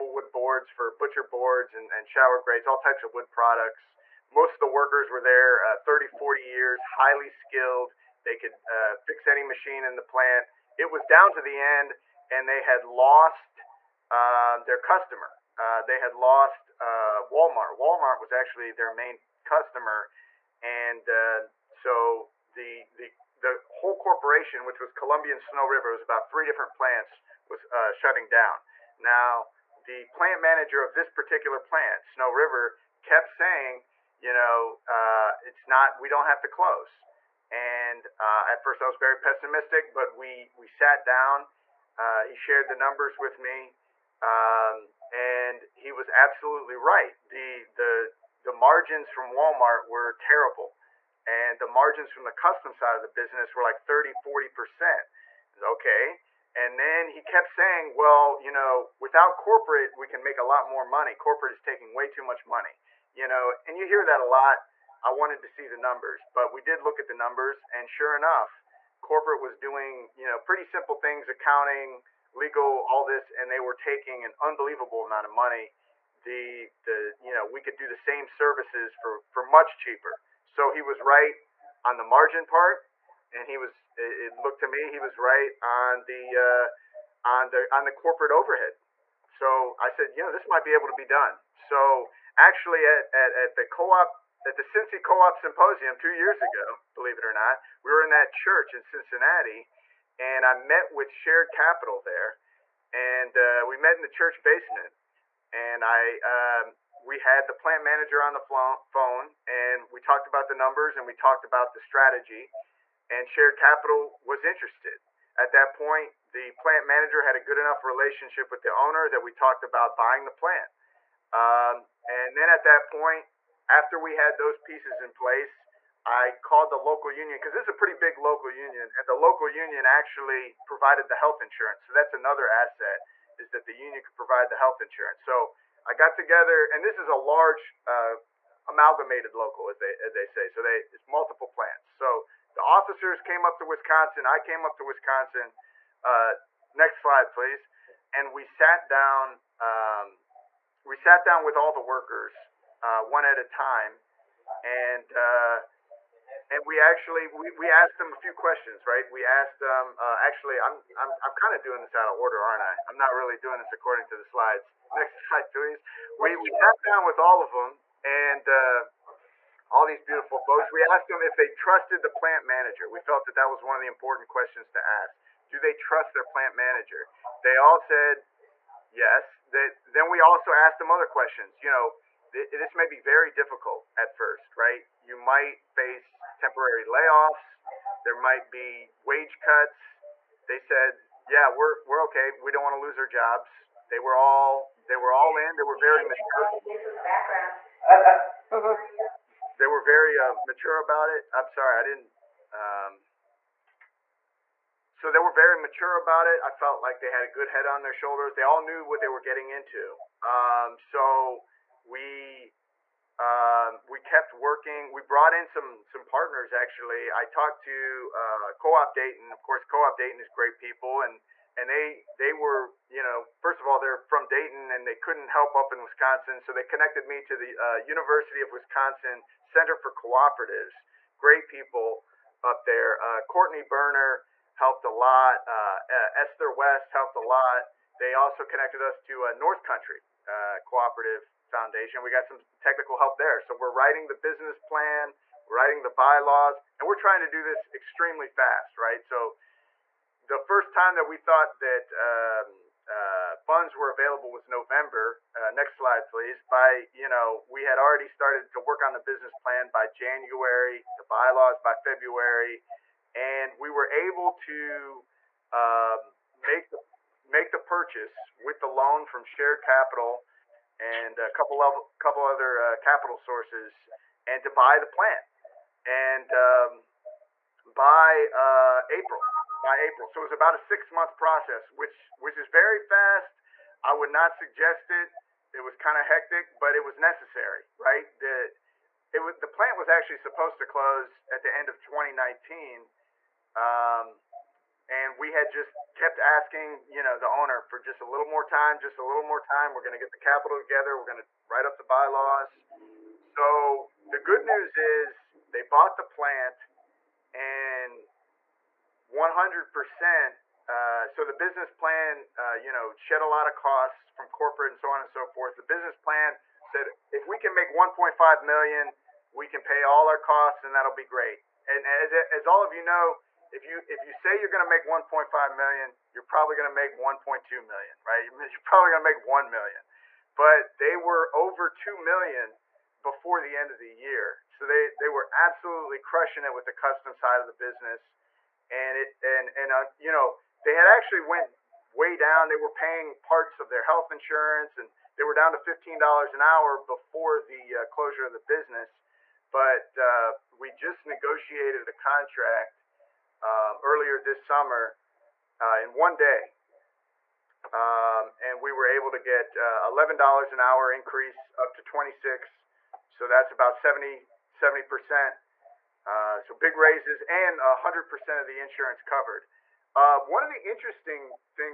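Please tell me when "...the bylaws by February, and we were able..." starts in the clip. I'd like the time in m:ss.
4:20.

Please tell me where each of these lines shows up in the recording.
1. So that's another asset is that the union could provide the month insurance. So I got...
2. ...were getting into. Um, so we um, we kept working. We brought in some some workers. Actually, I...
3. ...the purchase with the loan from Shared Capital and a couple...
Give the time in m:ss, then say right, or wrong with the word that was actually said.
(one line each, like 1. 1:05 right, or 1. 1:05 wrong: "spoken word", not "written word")
1. 2:11 wrong: "health", not "month"
2. 3:29 wrong: "partners", not "workers"
3. 4:27 right.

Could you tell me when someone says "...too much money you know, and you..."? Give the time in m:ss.
1:02.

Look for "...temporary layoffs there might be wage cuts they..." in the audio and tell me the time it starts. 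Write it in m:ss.
3:06.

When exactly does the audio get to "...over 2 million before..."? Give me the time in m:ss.
5:31.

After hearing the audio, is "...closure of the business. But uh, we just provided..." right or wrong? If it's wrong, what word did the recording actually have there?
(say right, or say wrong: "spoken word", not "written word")
wrong: "negotiated", not "provided".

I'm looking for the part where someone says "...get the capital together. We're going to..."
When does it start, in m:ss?
4:59.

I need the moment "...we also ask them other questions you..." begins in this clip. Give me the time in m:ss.
3:00.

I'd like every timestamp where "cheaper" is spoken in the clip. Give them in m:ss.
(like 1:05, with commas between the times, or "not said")
1:19.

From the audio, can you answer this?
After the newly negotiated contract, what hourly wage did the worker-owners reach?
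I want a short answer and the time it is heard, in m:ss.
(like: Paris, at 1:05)
$26, at 6:01.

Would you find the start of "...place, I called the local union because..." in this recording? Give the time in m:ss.
2:05.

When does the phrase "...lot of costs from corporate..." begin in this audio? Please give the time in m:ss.
5:13.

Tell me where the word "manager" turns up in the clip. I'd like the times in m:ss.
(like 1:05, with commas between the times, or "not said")
0:30, 1:47, 1:56, 2:52, 2:56.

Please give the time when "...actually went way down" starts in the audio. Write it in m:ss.
5:40.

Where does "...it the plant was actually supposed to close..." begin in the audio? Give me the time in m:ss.
4:49.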